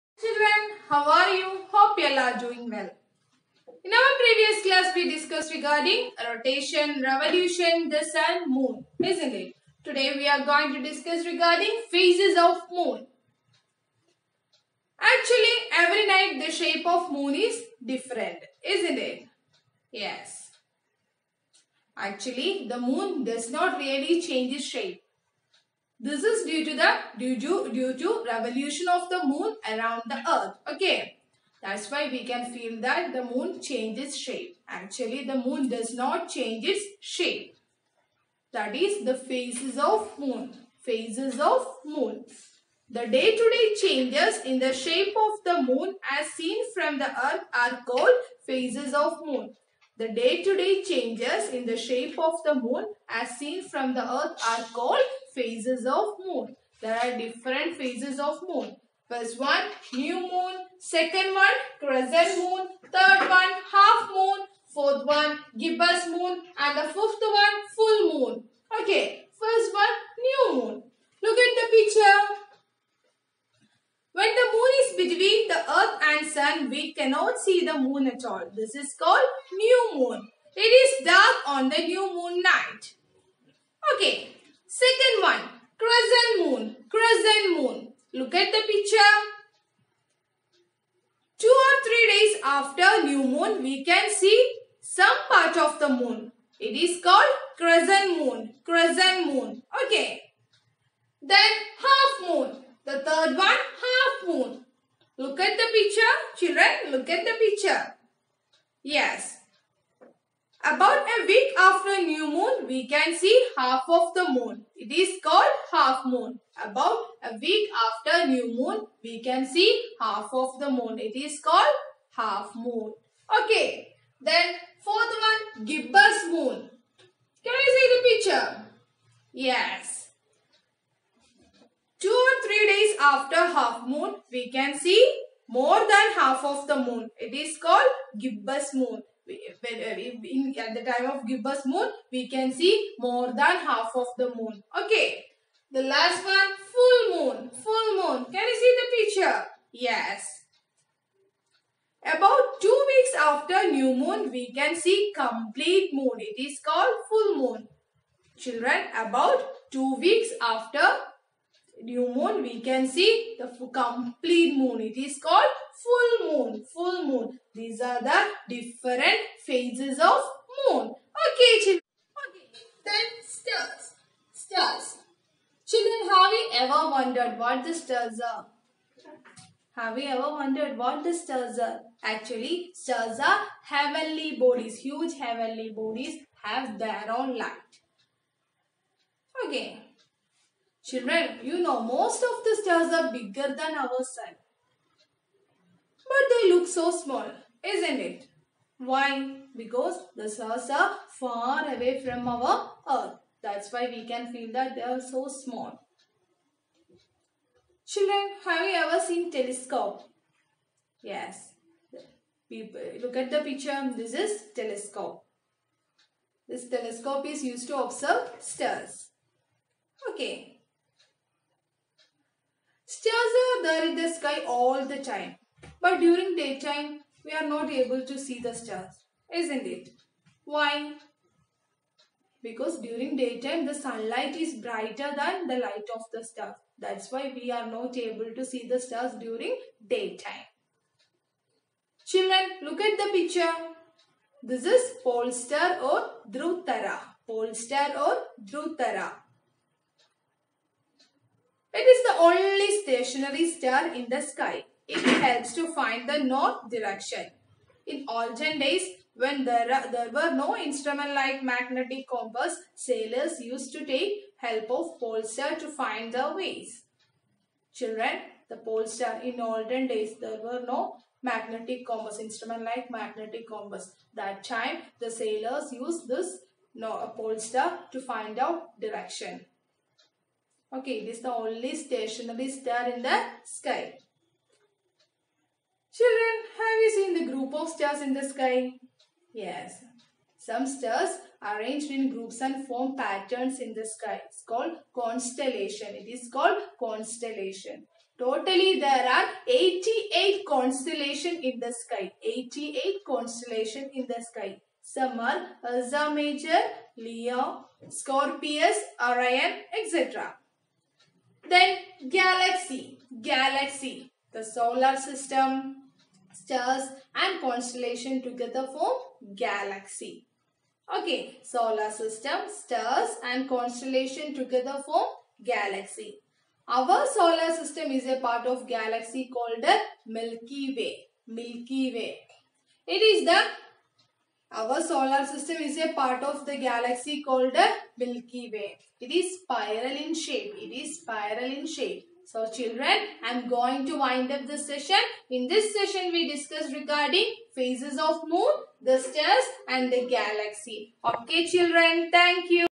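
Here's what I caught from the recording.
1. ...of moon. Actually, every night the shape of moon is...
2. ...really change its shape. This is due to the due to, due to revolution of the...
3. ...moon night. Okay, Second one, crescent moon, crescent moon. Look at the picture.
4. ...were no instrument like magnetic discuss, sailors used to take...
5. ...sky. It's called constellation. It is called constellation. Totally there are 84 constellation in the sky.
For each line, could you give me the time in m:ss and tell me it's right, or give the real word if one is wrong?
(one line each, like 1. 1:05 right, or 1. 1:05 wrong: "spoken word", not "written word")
1. 0:12 right
2. 0:23 right
3. 1:22 right
4. 4:20 wrong: "compass", not "discuss"
5. 4:53 wrong: "88", not "84".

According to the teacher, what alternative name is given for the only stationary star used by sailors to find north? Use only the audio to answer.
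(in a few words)
Drutara.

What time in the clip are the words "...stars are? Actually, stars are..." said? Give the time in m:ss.
3:01.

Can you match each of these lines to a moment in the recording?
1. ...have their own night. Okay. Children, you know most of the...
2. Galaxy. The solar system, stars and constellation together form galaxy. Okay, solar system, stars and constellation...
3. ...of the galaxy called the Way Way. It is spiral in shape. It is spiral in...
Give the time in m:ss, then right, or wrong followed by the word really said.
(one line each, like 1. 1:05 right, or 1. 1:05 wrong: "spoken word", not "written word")
1. 3:06 wrong: "light", not "night"
2. 5:13 right
3. 5:36 wrong: "Milky", not "Way".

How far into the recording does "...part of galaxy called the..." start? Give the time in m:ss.
5:28.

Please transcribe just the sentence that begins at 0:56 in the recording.
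There are different phases of moon.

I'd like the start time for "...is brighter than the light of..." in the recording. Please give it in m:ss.
3:54.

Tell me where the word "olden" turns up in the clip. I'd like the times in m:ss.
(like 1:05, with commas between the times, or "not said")
4:18, 4:29.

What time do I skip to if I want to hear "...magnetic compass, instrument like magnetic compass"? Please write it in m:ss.
4:31.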